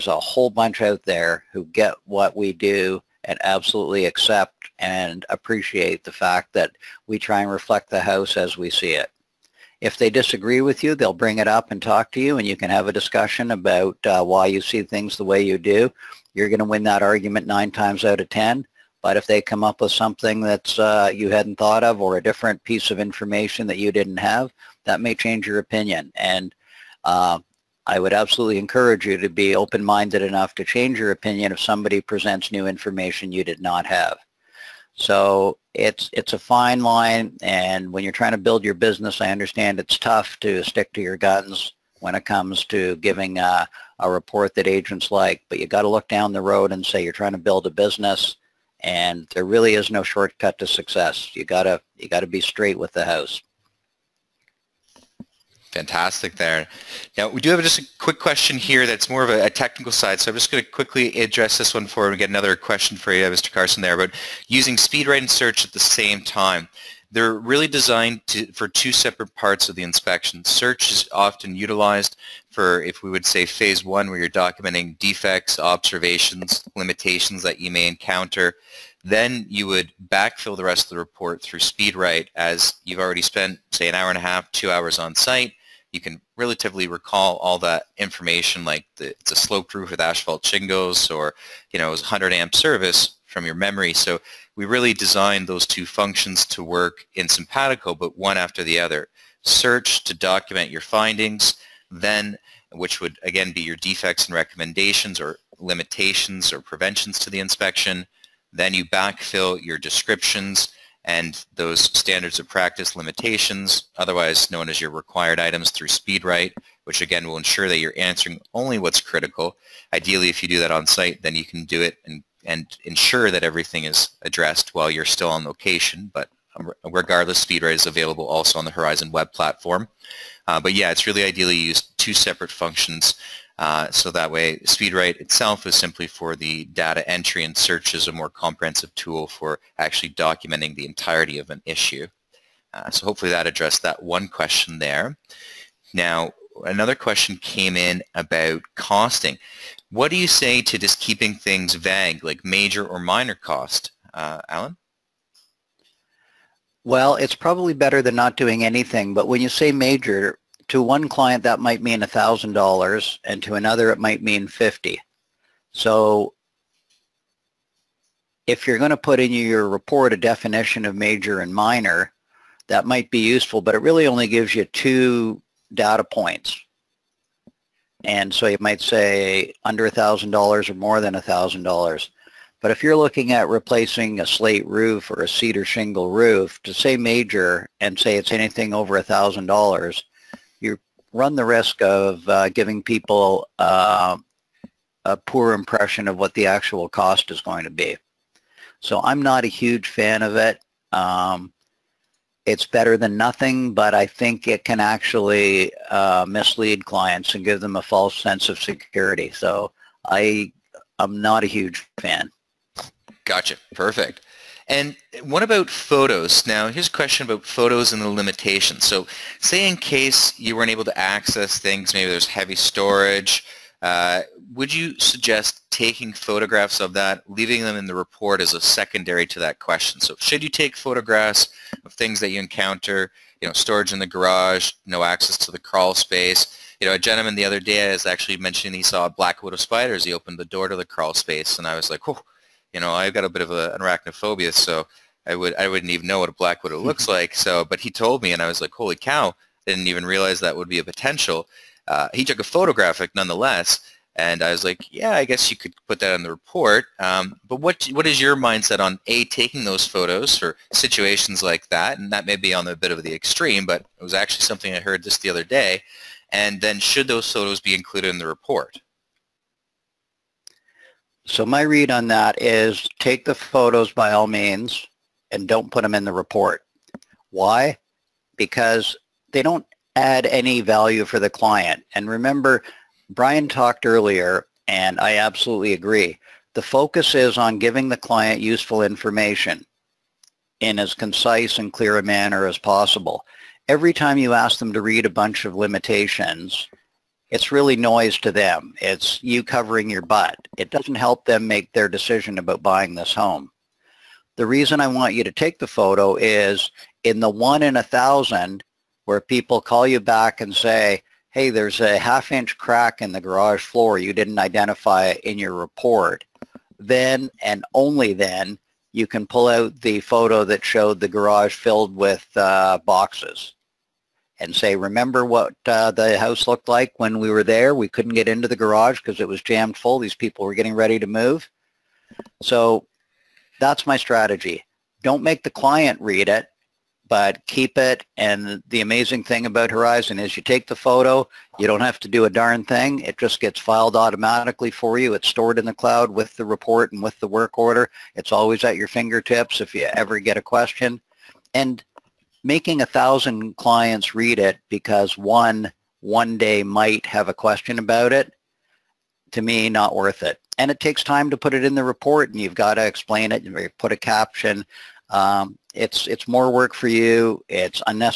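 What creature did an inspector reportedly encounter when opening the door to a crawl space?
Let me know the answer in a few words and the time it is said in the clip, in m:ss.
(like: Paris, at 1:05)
black widow spider, at 3:59.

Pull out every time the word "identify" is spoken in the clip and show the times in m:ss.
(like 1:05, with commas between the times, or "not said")
5:14.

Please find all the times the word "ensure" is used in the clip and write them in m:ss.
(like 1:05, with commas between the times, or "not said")
1:57, 2:02.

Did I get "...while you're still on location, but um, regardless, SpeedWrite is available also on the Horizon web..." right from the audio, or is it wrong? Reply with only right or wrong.
right.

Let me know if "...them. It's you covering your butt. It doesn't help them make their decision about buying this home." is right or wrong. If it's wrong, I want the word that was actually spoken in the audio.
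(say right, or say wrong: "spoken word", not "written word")
right.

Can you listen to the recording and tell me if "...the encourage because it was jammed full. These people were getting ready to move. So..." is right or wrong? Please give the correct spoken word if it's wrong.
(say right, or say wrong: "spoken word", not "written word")
wrong: "garage", not "encourage".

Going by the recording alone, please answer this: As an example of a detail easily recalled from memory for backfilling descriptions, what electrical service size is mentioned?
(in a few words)
100 amp.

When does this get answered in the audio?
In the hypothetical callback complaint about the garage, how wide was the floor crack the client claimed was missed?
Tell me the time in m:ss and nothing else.
5:11.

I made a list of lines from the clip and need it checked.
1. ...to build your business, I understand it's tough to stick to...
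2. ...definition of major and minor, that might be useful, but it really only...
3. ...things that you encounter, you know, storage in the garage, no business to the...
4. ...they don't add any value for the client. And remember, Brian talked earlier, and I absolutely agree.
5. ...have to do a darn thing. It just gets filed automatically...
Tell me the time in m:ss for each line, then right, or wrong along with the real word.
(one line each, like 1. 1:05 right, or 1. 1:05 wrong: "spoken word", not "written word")
1. 0:38 right
2. 2:50 right
3. 3:51 wrong: "access", not "business"
4. 4:39 right
5. 5:41 right.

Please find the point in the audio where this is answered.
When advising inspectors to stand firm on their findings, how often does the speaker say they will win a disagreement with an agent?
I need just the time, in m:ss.
0:17.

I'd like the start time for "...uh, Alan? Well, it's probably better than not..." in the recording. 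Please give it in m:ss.
2:34.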